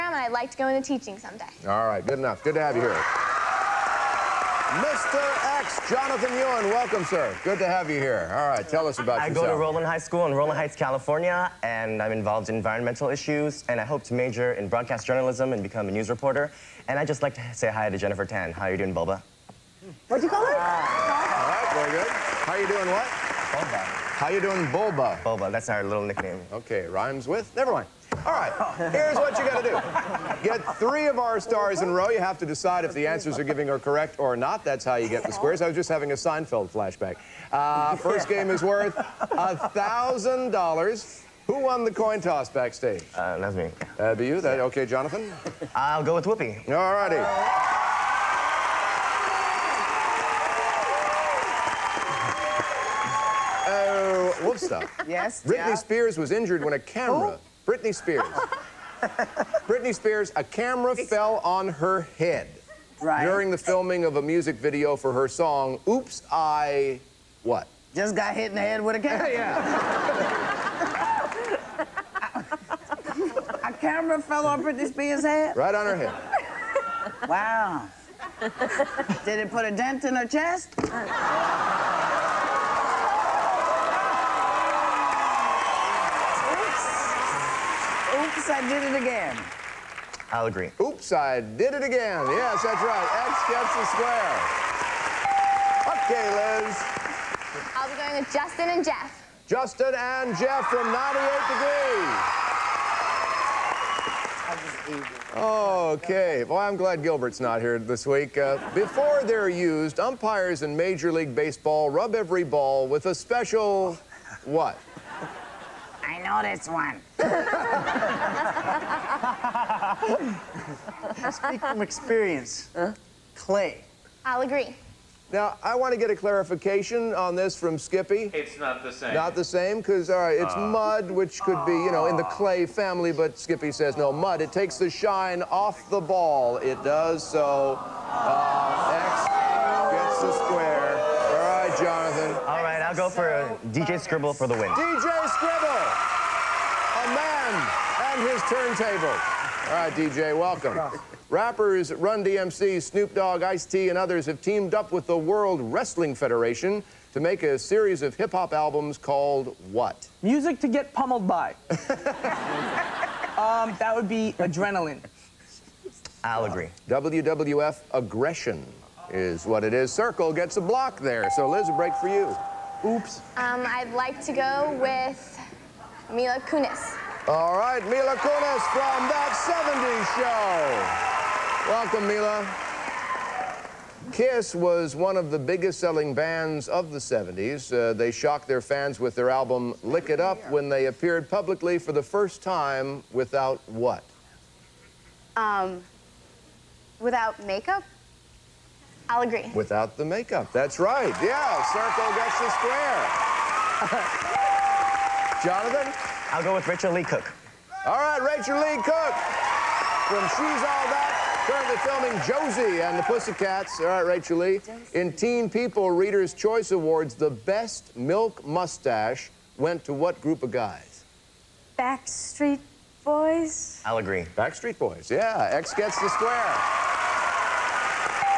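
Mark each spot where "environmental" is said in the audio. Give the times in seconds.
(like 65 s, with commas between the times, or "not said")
12 s.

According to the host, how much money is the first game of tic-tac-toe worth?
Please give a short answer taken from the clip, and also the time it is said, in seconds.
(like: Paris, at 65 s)
$1,000, at 38 s.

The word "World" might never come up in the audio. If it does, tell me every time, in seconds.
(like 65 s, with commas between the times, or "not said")
155 s.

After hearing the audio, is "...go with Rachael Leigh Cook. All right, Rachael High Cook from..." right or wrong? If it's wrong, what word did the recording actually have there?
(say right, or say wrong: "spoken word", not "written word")
wrong: "Leigh", not "High".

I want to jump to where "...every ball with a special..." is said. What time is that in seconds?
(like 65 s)
112 s.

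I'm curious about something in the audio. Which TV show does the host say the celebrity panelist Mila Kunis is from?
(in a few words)
That 70s Show.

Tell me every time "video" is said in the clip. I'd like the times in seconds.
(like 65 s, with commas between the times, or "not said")
64 s.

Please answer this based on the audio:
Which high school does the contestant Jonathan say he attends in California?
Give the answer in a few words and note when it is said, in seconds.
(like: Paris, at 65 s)
Rowland High School, at 9 s.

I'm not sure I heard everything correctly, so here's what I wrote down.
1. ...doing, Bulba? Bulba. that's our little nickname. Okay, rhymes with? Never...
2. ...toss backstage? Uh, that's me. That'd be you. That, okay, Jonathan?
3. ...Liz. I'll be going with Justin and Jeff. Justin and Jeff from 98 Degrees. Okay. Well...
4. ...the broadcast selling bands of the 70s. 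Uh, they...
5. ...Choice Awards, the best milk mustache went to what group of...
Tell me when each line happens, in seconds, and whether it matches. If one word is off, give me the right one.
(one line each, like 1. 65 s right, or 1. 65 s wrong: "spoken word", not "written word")
1. 24 s right
2. 42 s right
3. 96 s right
4. 185 s wrong: "biggest", not "broadcast"
5. 216 s right.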